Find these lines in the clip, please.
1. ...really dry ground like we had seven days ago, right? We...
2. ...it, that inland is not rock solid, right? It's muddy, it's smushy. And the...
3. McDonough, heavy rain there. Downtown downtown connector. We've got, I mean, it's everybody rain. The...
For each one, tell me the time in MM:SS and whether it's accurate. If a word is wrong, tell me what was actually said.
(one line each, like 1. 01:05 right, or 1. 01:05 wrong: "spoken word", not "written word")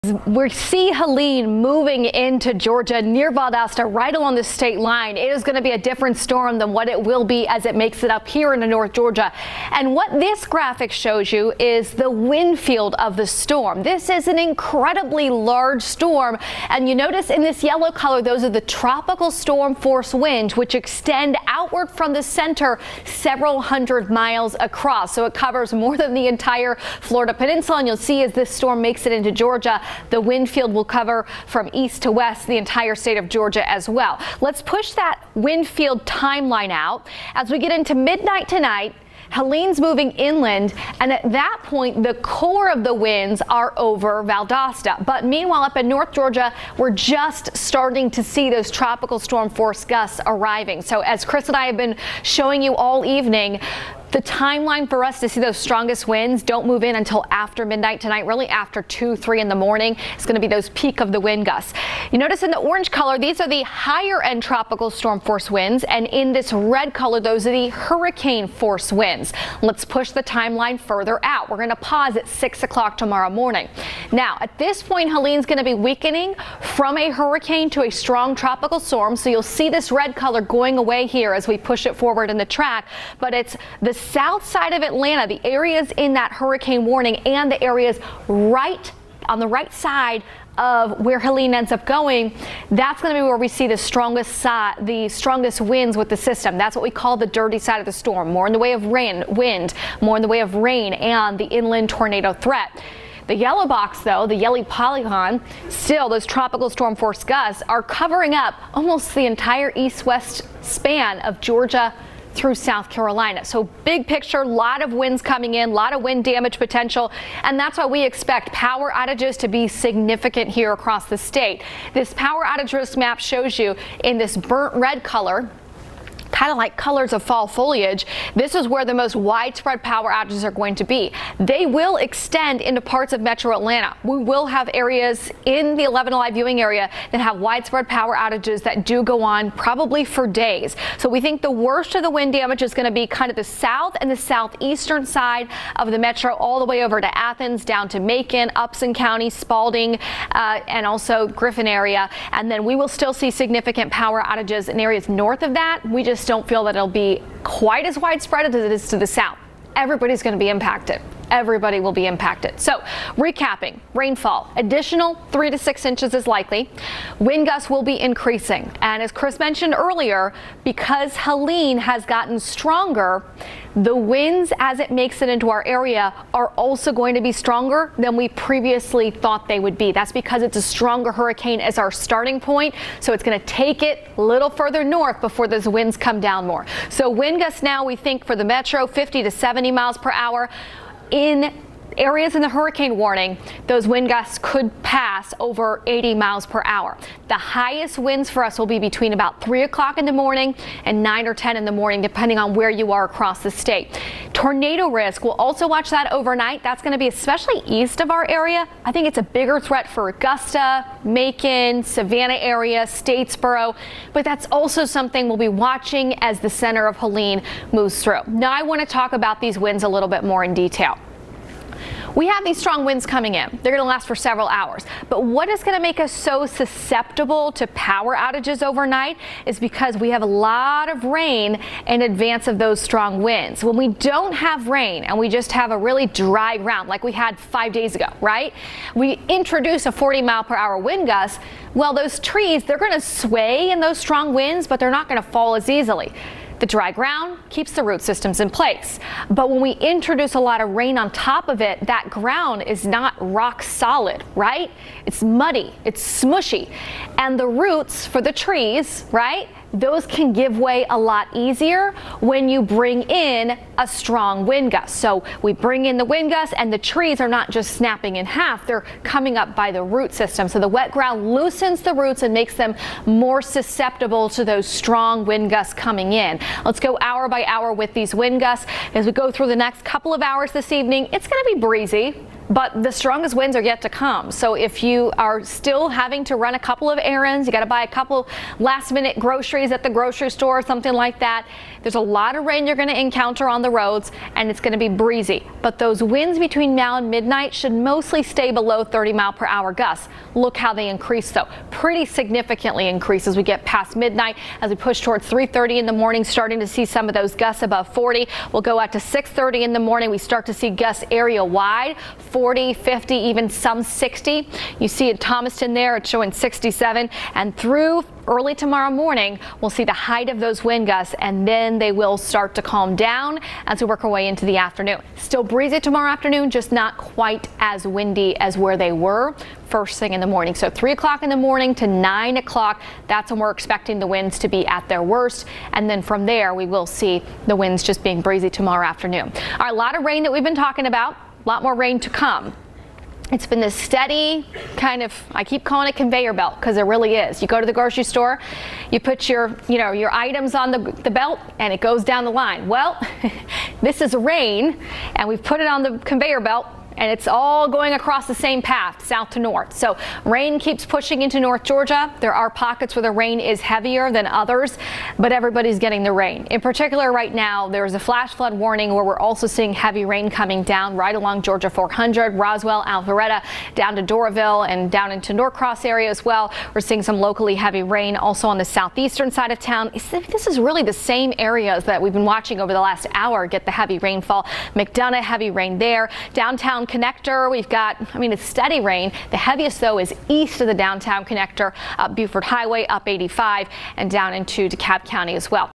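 1. 03:55 wrong: "five", not "seven"
2. 04:11 wrong: "ground", not "inland"
3. 06:24 wrong: "steady", not "everybody".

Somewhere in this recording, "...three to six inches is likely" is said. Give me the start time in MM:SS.
02:45.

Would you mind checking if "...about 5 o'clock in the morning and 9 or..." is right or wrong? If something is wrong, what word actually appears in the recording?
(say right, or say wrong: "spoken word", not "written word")
wrong: "3", not "5".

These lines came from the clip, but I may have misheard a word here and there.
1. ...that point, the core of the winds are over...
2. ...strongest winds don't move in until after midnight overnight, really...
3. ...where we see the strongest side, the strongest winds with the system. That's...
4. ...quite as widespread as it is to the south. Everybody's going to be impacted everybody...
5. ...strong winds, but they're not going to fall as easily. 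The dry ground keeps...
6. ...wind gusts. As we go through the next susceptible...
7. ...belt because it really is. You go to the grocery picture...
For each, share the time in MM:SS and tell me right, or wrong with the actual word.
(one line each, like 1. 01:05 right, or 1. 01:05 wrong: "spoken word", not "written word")
1. 00:41 right
2. 00:55 wrong: "tonight", not "overnight"
3. 01:33 right
4. 02:37 right
5. 04:03 right
6. 04:38 wrong: "couple", not "susceptible"
7. 05:46 wrong: "store", not "picture".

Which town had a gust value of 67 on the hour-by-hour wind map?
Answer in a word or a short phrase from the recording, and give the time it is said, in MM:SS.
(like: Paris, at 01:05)
Thomaston, at 05:15.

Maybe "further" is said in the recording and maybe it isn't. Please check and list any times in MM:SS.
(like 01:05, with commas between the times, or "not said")
01:10, 03:04.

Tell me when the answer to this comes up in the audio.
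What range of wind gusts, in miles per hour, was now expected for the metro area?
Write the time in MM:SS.
03:08.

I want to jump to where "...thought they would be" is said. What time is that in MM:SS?
02:59.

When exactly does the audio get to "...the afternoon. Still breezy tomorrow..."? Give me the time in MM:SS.
05:24.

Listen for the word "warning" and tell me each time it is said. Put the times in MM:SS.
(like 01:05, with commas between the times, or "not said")
01:26, 03:12, 06:08.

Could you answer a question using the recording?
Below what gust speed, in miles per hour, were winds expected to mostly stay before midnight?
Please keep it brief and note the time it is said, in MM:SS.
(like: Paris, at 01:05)
30 mph, at 04:58.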